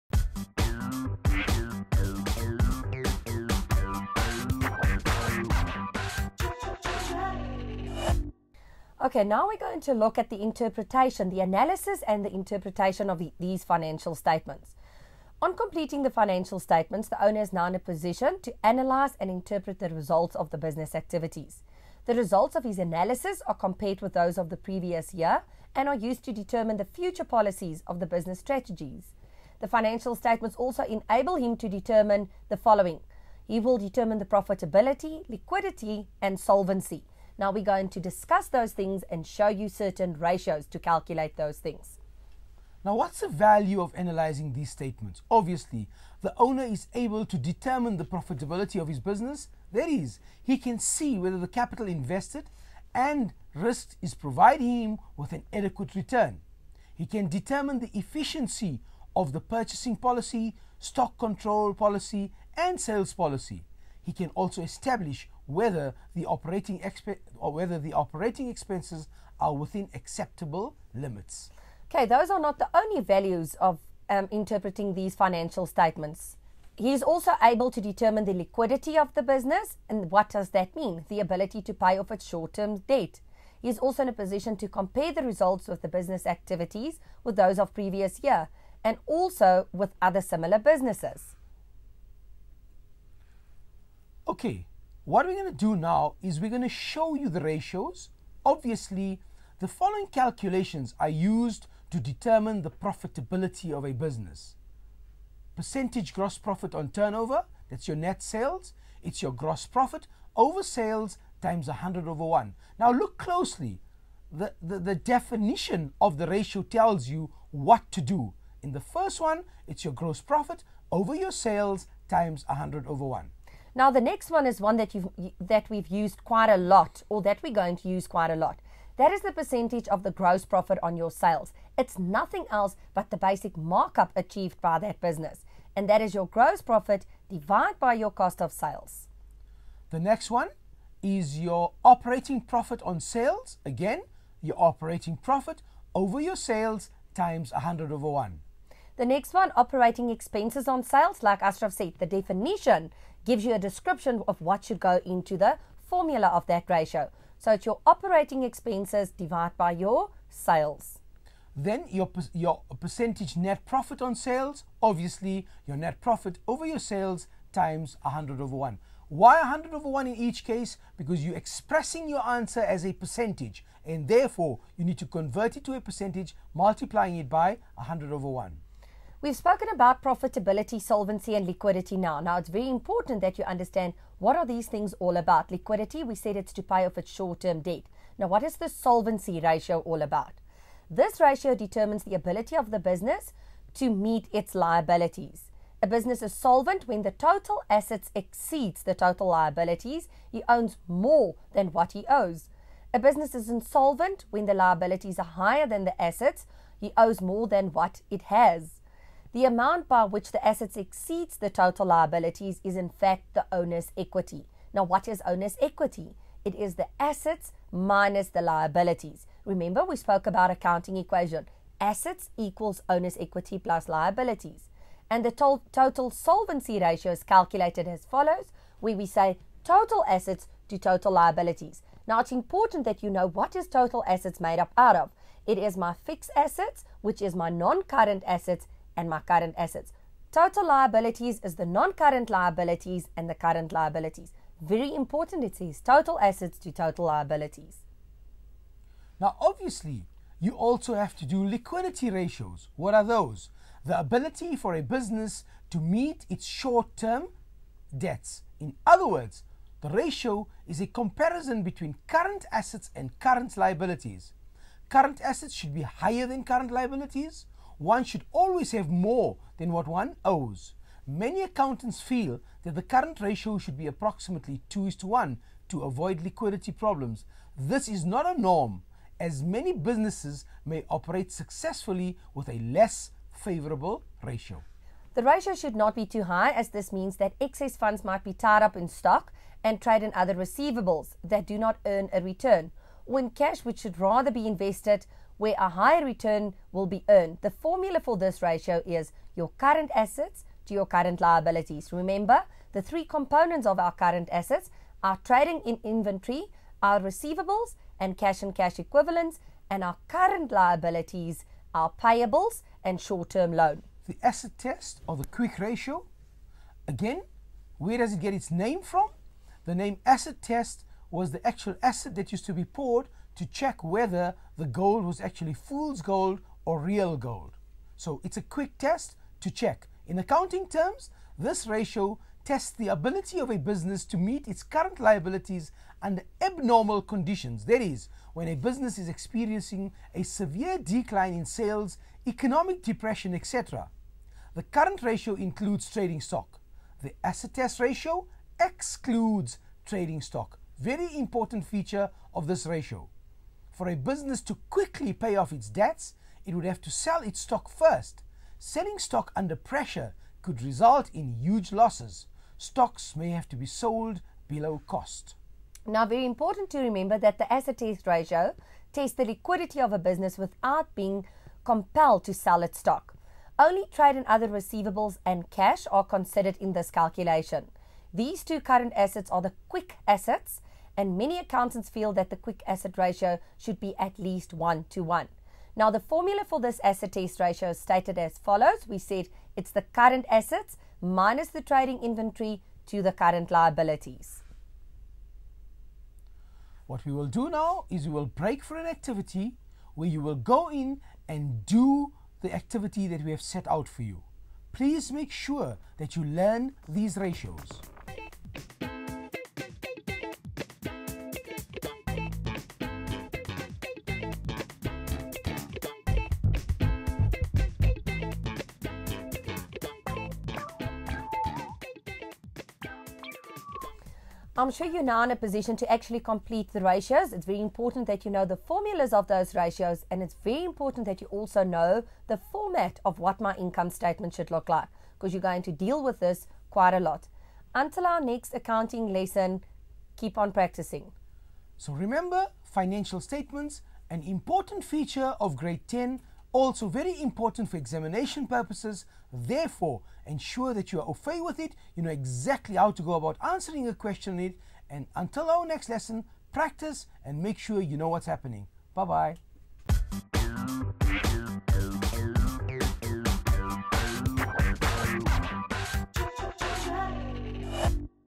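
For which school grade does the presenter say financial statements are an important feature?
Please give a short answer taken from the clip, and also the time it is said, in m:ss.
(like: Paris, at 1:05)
grade 10, at 7:25.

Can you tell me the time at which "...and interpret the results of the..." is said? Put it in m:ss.
0:19.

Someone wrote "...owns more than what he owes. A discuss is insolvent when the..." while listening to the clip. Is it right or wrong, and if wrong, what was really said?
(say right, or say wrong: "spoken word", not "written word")
wrong: "business", not "discuss".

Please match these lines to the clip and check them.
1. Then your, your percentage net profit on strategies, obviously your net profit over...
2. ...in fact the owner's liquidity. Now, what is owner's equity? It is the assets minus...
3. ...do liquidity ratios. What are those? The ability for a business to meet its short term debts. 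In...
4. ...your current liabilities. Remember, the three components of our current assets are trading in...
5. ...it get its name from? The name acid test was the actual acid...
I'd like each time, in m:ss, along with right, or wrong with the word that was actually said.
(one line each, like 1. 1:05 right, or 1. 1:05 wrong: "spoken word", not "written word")
1. 2:41 wrong: "sales", not "strategies"
2. 3:32 wrong: "equity", not "liquidity"
3. 4:11 right
4. 5:00 right
5. 5:18 right.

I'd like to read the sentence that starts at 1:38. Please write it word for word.
Obviously, the following calculations are used to determine the profitability of a business.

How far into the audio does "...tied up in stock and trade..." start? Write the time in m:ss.
4:48.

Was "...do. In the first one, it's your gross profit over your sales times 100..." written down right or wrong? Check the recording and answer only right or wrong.
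right.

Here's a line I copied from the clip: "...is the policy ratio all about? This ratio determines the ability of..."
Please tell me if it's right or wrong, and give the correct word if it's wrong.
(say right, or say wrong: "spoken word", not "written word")
wrong: "solvency", not "policy".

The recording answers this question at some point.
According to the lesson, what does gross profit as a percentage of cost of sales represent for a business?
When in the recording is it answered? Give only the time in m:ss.
2:13.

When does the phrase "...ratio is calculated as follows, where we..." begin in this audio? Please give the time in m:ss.
3:46.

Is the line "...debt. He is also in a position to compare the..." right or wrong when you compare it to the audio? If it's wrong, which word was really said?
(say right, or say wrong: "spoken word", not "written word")
right.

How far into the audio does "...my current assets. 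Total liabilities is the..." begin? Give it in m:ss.
3:59.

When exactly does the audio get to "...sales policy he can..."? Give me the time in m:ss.
1:02.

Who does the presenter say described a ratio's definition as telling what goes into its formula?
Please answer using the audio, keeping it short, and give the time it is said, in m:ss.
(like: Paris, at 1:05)
Ashraf, at 2:31.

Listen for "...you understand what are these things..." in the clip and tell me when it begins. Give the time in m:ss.
3:03.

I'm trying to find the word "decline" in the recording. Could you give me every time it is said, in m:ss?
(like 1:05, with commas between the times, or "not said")
5:40.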